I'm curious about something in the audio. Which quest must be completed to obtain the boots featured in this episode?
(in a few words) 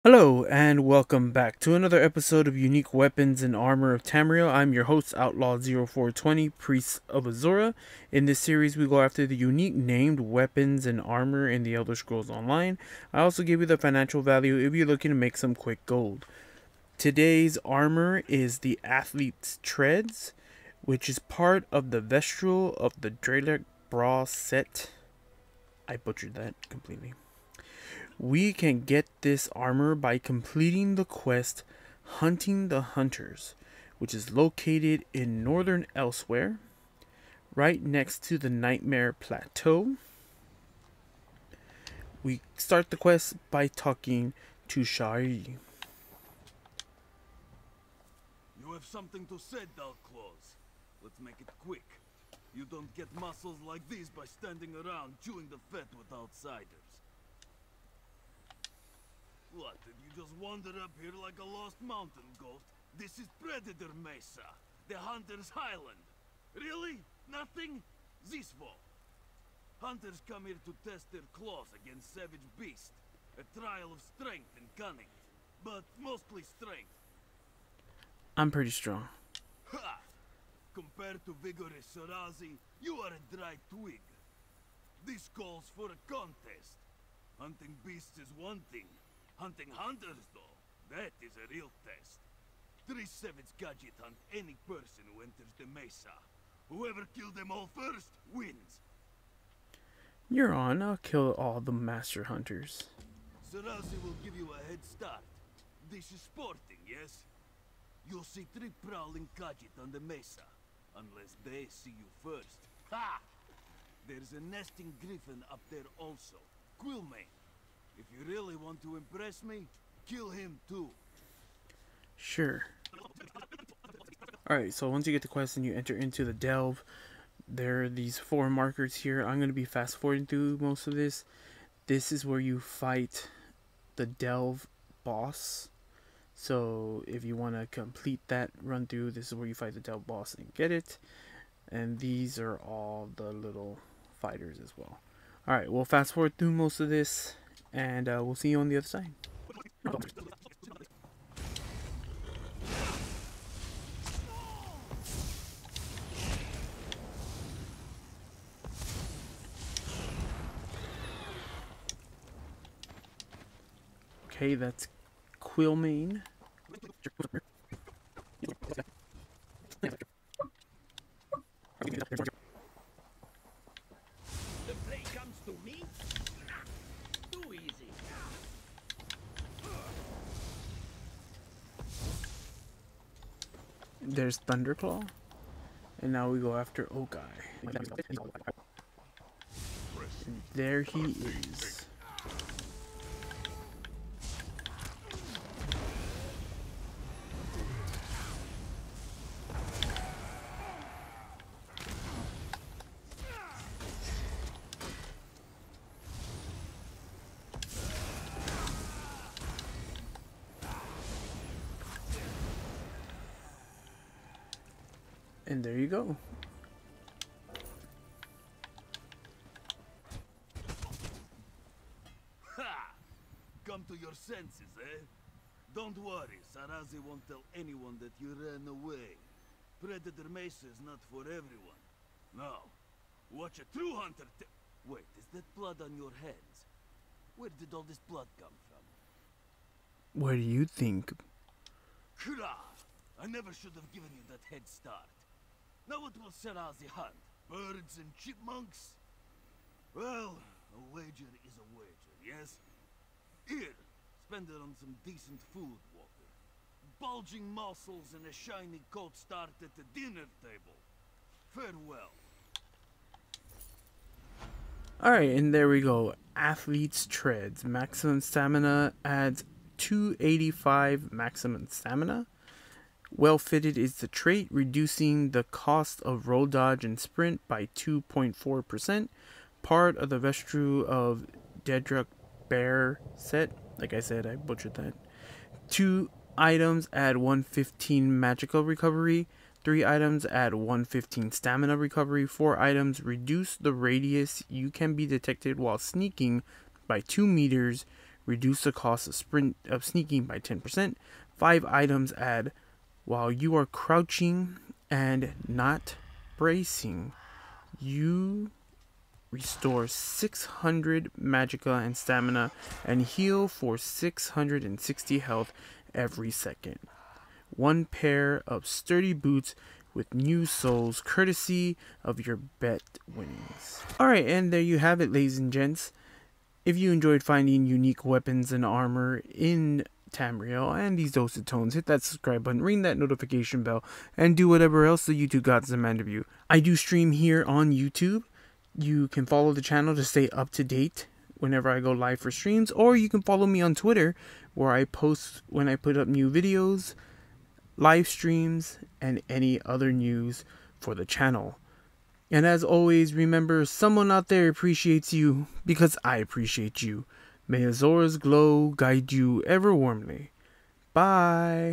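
Hunting the Hunters.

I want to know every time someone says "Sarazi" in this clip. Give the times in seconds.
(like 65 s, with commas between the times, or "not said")
81 s, 103 s, 226 s.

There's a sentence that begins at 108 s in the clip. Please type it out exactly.
You'll see three prowling gadget on the mesa.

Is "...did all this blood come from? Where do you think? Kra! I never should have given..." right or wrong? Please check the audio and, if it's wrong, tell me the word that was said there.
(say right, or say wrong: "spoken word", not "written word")
right.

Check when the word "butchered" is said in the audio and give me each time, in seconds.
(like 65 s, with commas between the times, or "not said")
25 s, 284 s.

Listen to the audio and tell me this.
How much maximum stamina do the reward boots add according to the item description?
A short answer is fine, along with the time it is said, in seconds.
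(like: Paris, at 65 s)
285, at 269 s.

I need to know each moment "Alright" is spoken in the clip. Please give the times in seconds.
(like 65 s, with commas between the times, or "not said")
124 s, 145 s, 265 s, 323 s.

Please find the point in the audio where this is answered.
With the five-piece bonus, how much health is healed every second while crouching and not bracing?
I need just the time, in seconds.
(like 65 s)
313 s.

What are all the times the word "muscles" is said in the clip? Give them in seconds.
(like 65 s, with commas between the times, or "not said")
53 s, 257 s.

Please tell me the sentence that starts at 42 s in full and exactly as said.
We start the quest by talking to Shari.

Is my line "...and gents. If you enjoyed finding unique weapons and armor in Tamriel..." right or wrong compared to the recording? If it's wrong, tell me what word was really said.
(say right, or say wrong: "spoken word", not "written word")
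right.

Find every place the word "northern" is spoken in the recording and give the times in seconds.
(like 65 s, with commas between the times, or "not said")
35 s.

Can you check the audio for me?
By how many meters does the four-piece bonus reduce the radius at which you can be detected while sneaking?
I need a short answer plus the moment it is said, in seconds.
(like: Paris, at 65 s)
2 meters, at 297 s.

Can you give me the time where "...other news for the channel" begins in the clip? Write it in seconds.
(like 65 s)
349 s.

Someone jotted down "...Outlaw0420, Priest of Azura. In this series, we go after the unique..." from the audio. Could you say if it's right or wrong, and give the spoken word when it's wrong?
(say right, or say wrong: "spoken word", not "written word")
right.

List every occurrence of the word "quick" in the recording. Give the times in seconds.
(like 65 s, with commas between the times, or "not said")
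15 s, 51 s.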